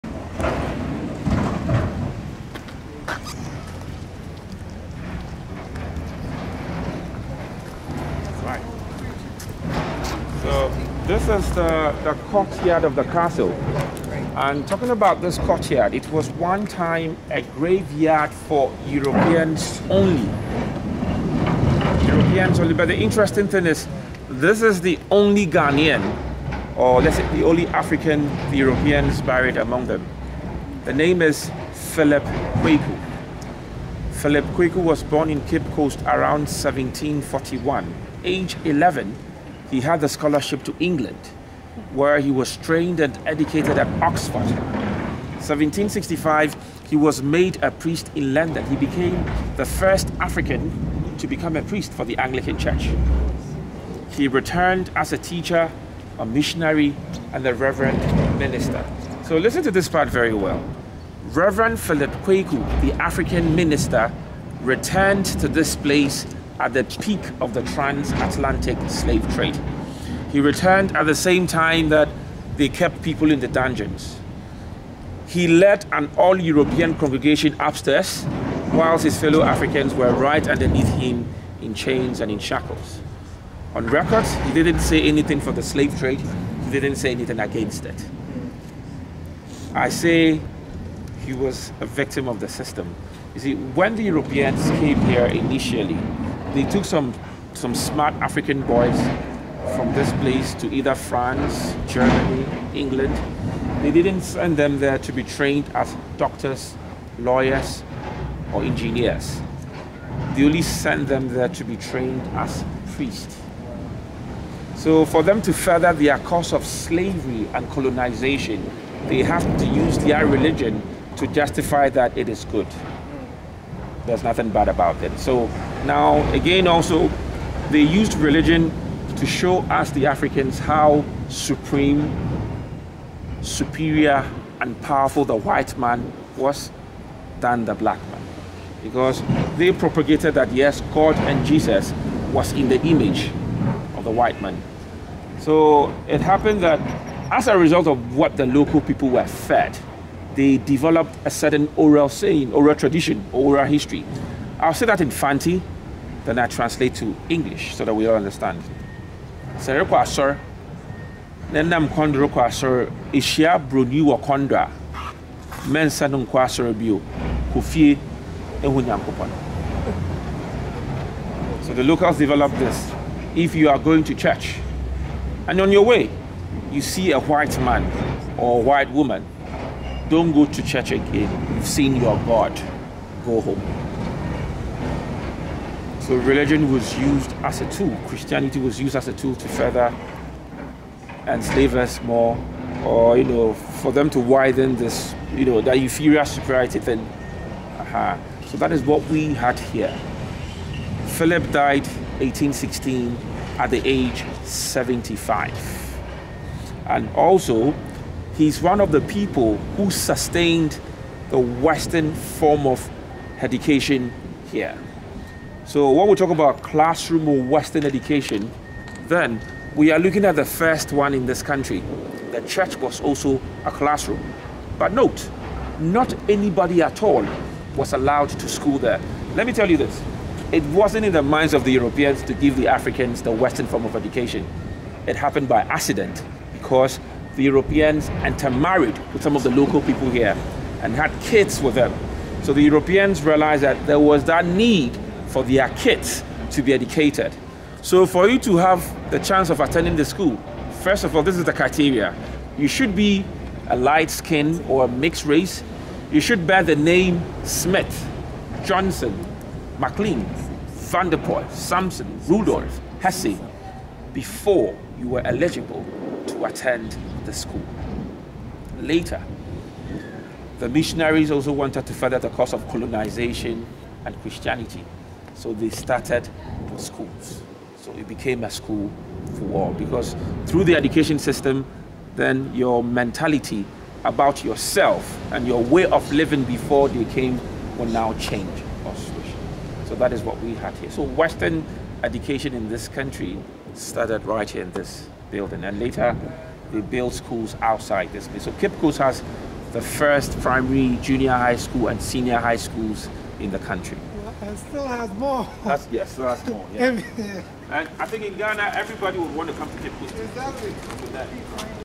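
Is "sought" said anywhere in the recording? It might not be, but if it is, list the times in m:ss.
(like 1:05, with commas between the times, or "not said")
not said.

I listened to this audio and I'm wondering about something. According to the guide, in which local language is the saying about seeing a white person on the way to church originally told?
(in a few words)
Fanti.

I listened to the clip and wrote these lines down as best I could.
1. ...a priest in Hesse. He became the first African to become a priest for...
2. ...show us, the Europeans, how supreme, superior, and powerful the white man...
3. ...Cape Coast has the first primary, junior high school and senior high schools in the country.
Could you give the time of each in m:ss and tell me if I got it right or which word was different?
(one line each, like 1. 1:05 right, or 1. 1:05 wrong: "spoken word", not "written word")
1. 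0:47 wrong: "London", not "Hesse"
2. 2:09 wrong: "Africans", not "Europeans"
3. 4:58 right.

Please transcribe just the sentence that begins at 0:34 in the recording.
Philip Quaque was born in Cape Coast around 1741.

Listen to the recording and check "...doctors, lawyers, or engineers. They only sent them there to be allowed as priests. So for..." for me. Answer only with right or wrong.
wrong.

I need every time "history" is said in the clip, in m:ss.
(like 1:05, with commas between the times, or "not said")
2:33.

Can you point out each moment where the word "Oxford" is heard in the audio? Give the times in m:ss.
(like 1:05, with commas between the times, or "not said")
0:44.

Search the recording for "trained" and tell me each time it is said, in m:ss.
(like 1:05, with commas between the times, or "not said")
0:42, 1:45, 1:51.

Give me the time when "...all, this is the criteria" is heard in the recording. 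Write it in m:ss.
4:11.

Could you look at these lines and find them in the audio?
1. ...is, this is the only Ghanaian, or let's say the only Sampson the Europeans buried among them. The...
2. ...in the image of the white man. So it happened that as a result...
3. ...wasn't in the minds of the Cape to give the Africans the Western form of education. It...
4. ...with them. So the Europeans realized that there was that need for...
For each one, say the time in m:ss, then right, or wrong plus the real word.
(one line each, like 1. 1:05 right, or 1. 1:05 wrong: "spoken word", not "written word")
1. 0:23 wrong: "African", not "Sampson"
2. 2:22 right
3. 3:50 wrong: "Europeans", not "Cape"
4. 4:01 right.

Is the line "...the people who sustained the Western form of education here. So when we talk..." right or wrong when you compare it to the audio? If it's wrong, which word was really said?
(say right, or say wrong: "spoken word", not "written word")
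right.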